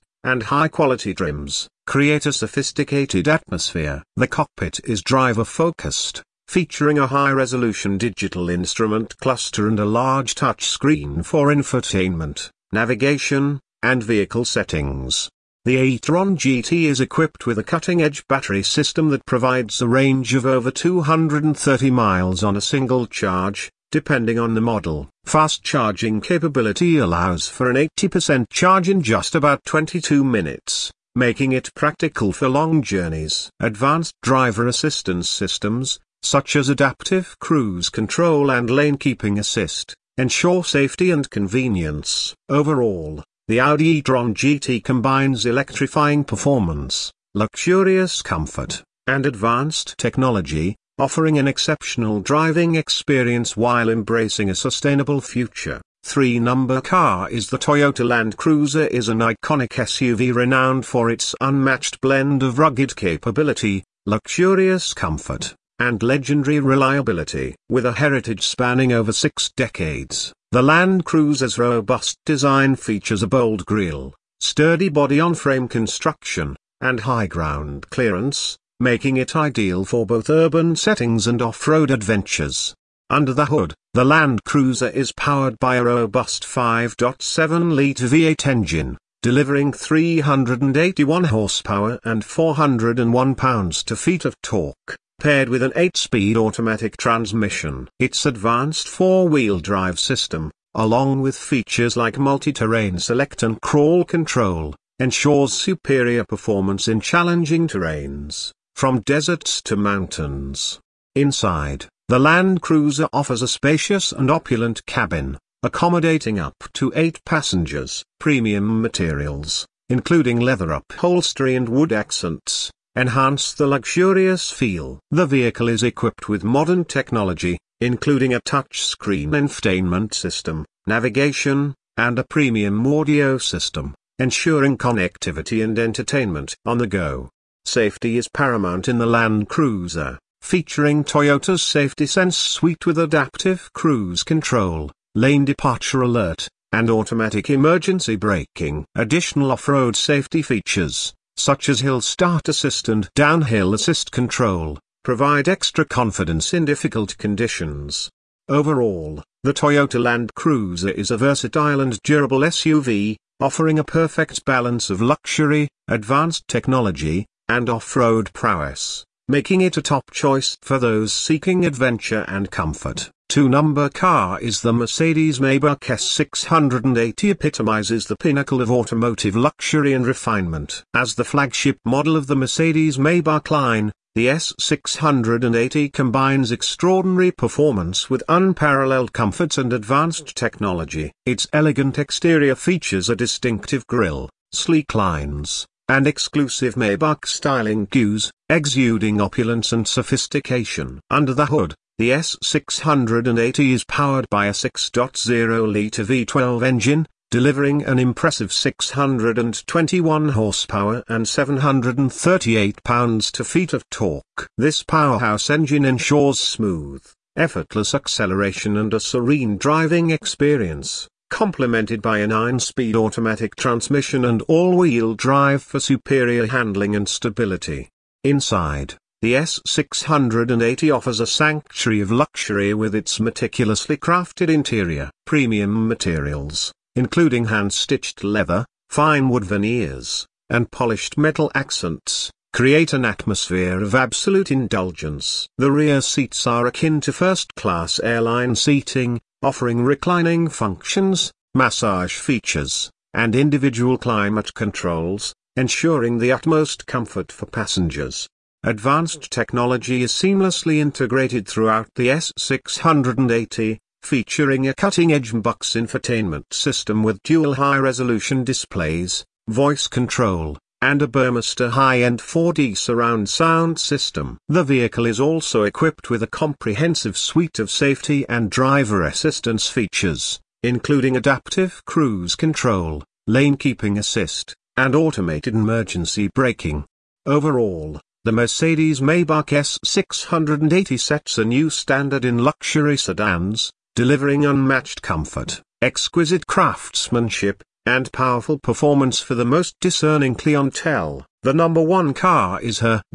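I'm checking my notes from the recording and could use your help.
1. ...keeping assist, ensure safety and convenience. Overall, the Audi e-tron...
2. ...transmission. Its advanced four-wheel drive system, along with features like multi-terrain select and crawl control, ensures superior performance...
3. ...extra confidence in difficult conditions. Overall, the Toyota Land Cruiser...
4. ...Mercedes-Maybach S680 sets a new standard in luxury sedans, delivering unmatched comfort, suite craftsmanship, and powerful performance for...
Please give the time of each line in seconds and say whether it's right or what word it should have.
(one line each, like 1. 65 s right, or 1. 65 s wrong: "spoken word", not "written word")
1. 38 s right
2. 96 s right
3. 155 s right
4. 288 s wrong: "exquisite", not "suite".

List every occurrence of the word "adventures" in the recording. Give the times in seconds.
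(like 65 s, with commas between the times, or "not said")
81 s, 171 s.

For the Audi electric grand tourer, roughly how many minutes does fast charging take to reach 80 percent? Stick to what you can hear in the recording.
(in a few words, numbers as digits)
22.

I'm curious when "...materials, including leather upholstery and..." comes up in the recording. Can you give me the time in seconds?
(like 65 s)
118 s.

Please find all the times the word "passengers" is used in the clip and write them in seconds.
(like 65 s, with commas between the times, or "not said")
117 s, 257 s.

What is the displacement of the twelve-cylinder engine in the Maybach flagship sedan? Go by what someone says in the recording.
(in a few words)
6.0-litre.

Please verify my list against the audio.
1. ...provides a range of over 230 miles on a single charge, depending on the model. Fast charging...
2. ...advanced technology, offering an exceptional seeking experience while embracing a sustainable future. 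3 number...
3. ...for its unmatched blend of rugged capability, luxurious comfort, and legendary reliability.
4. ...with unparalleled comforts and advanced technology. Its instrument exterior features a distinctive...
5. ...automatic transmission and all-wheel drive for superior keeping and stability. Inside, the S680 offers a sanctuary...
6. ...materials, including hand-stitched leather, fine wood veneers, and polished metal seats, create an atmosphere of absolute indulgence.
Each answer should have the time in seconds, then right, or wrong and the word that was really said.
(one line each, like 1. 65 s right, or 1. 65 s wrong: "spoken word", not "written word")
1. 19 s right
2. 49 s wrong: "driving", not "seeking"
3. 60 s right
4. 188 s wrong: "elegant", not "instrument"
5. 222 s wrong: "handling", not "keeping"
6. 235 s wrong: "accents", not "seats".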